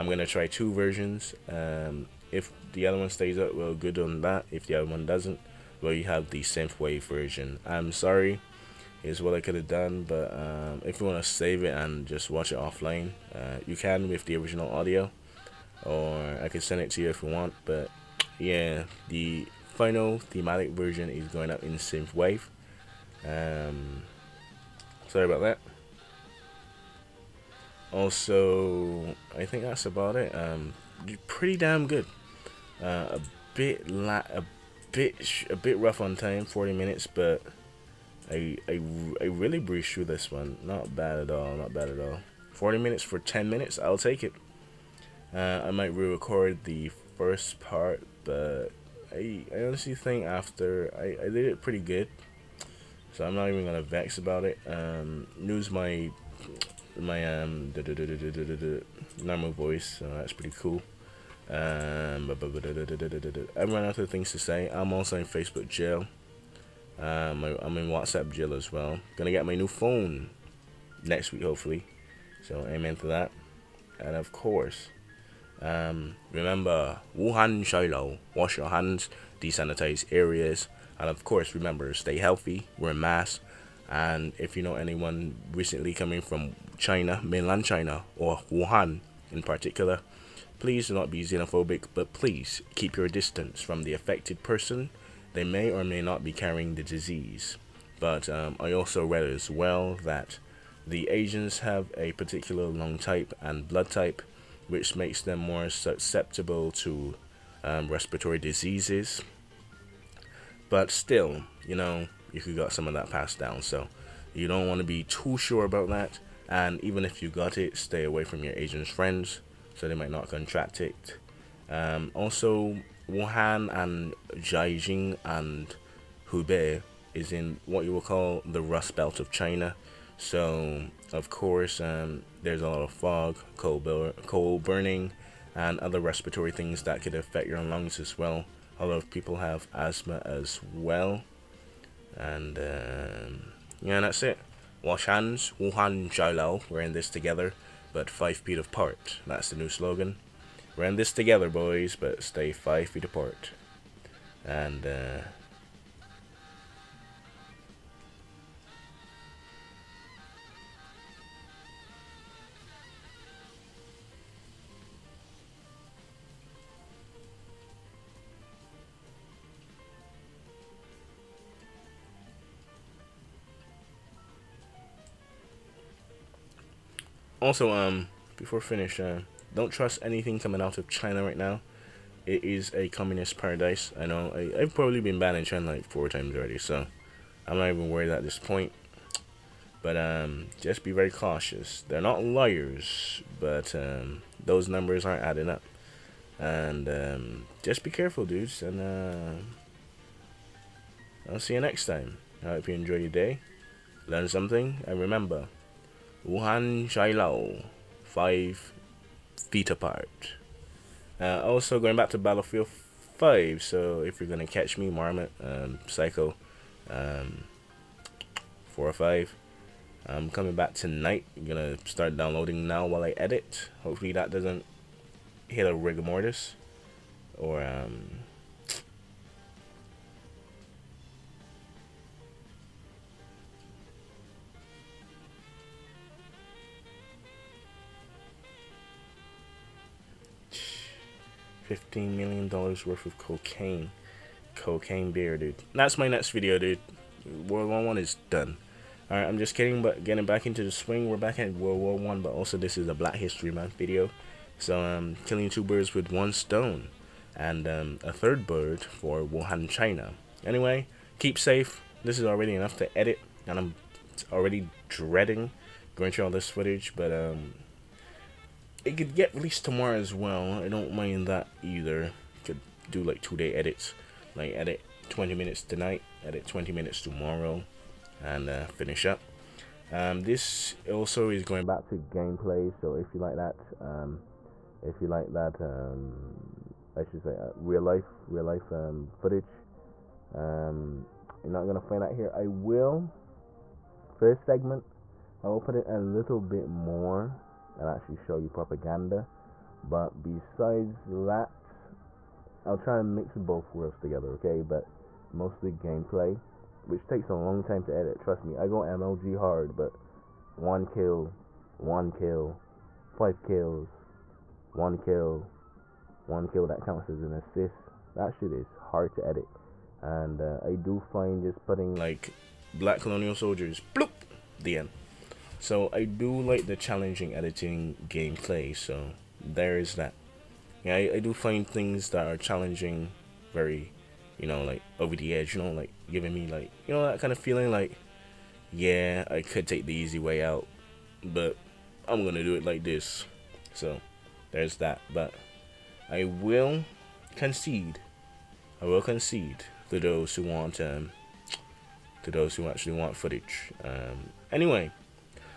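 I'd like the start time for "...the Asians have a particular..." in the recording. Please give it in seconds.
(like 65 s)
100 s.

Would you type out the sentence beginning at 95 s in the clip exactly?
They may or may not be carrying the disease.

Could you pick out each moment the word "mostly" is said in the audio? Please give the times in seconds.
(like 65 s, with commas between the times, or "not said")
305 s.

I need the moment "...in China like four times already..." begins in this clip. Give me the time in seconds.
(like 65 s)
185 s.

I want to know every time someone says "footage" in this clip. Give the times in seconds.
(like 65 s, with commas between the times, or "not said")
266 s, 289 s, 353 s.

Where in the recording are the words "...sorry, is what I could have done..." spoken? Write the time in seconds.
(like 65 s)
7 s.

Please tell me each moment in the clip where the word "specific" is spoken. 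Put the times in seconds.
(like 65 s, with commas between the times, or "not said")
not said.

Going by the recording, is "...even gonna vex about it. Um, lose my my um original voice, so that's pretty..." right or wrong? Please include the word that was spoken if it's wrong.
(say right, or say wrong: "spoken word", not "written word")
wrong: "normal", not "original".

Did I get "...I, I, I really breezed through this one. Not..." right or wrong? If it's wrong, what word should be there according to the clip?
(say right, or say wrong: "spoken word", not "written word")
right.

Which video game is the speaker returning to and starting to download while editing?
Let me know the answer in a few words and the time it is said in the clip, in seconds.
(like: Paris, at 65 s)
Battlefield 5, at 212 s.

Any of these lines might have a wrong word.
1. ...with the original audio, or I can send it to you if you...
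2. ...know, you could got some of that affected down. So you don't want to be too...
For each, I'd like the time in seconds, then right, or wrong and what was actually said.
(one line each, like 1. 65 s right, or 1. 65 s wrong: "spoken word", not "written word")
1. 14 s right
2. 111 s wrong: "passed", not "affected".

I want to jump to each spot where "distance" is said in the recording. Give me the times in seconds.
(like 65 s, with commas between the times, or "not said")
93 s.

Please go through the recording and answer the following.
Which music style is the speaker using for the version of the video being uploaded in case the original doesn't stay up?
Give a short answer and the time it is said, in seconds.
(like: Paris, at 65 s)
synthwave, at 21 s.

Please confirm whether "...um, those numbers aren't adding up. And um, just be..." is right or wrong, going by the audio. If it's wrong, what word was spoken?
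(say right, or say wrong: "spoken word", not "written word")
right.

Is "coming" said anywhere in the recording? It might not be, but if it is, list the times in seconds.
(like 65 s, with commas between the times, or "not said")
85 s, 180 s, 220 s.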